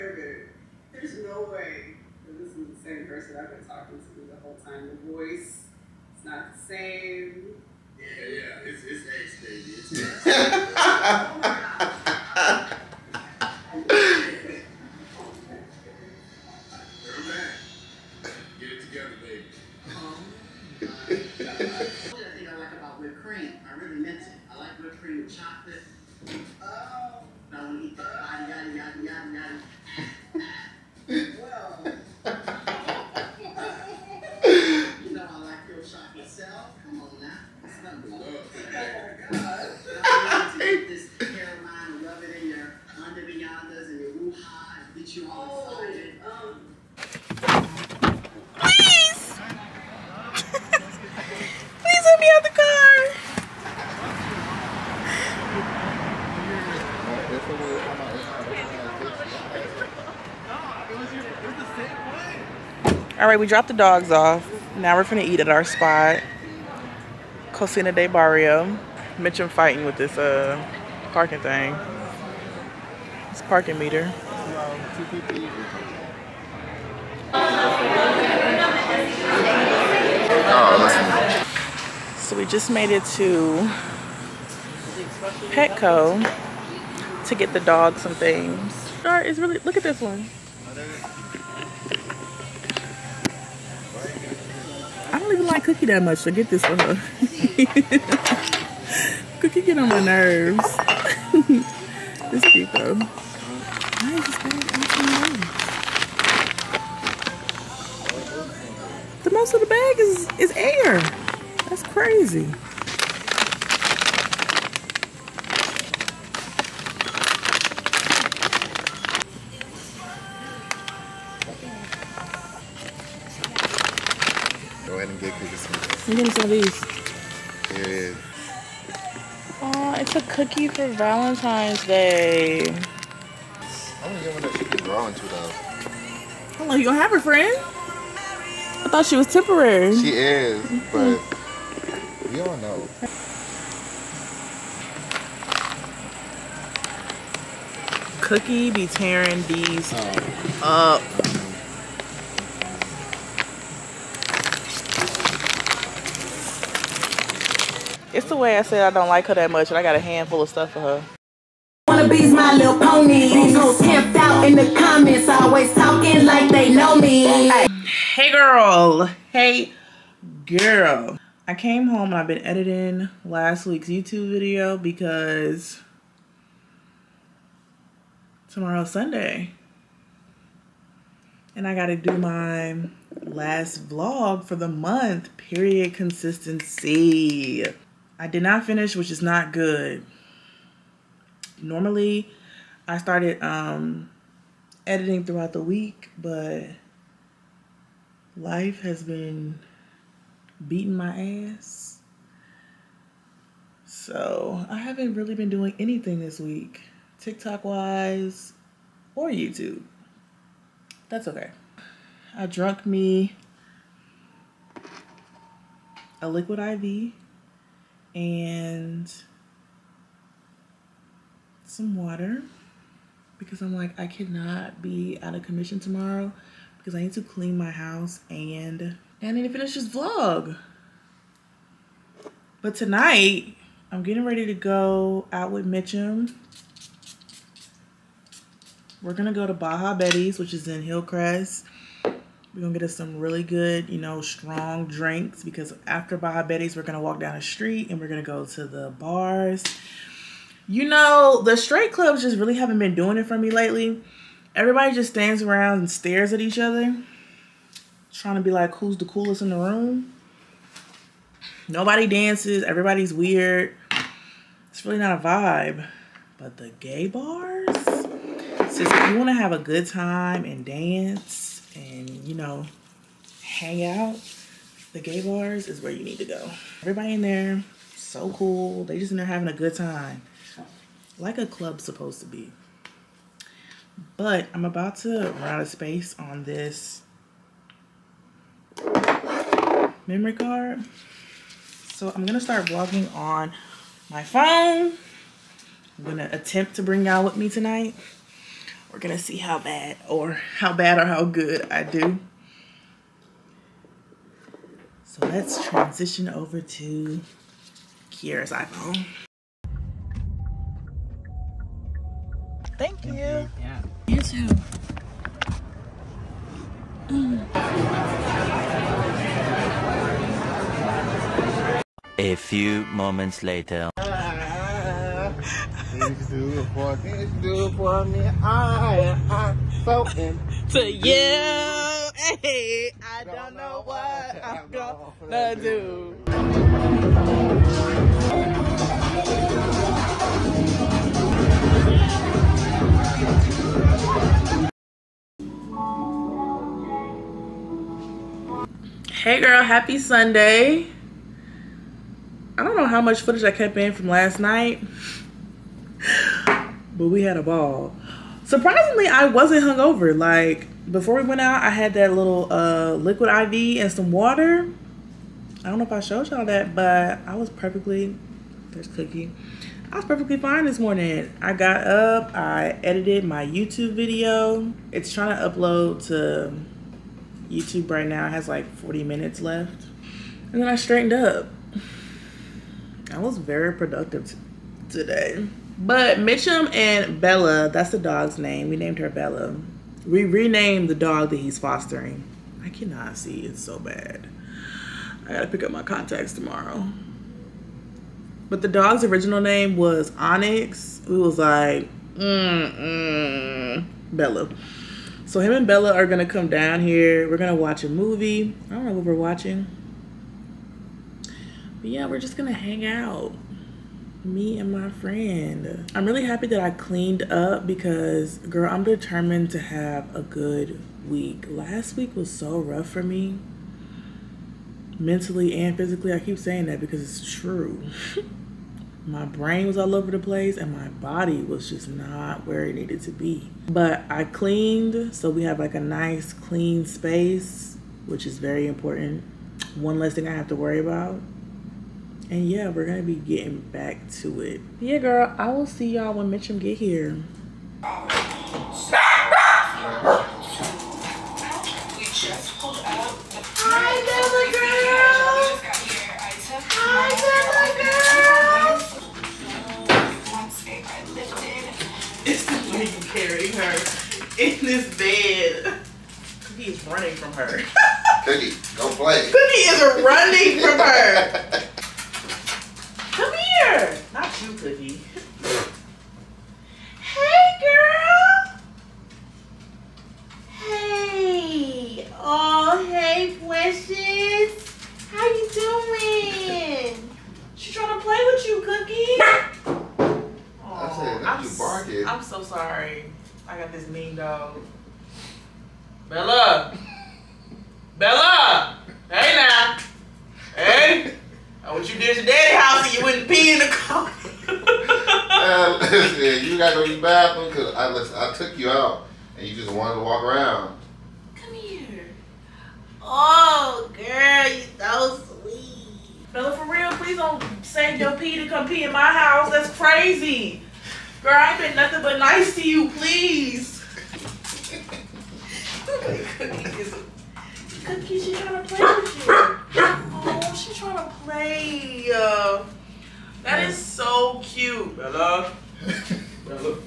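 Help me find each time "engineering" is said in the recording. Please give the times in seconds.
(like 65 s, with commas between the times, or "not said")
not said.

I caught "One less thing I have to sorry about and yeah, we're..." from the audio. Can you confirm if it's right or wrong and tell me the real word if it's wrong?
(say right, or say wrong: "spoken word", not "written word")
wrong: "worry", not "sorry".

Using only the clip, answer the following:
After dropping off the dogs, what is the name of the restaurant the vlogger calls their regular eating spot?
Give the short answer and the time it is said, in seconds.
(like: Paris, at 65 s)
Cocina de Barrio, at 67 s.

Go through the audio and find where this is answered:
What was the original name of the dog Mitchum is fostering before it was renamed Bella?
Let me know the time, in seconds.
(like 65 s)
400 s.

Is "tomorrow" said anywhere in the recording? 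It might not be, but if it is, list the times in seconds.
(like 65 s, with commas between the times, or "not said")
178 s, 225 s, 396 s.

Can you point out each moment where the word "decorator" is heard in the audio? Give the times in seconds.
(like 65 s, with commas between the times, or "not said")
not said.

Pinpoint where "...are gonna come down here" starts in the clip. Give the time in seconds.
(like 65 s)
405 s.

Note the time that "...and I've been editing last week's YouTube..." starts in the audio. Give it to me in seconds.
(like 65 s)
172 s.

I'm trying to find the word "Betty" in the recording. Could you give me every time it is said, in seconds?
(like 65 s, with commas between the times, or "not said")
239 s, 246 s.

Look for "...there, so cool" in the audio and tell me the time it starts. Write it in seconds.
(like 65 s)
277 s.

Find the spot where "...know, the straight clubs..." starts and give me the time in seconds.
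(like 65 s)
250 s.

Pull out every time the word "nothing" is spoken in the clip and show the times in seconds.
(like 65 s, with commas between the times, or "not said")
521 s.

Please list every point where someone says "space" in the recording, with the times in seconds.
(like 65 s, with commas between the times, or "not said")
285 s, 436 s.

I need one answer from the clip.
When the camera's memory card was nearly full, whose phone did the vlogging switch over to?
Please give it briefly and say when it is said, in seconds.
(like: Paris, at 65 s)
Kiaira's iPhone, at 308 s.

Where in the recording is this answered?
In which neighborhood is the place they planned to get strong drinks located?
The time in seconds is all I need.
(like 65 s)
240 s.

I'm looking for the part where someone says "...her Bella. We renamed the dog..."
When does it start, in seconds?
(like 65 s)
388 s.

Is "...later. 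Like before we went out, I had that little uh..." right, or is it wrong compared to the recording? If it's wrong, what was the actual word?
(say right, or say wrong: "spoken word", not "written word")
wrong: "hungover", not "later".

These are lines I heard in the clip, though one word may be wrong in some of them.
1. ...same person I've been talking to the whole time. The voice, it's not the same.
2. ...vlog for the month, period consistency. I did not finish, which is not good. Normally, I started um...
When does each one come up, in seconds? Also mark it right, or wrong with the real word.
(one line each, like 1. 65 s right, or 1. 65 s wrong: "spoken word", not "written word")
1. 2 s right
2. 183 s right.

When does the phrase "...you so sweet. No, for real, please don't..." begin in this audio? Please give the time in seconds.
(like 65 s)
514 s.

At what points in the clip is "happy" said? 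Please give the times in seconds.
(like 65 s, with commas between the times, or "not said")
349 s, 416 s.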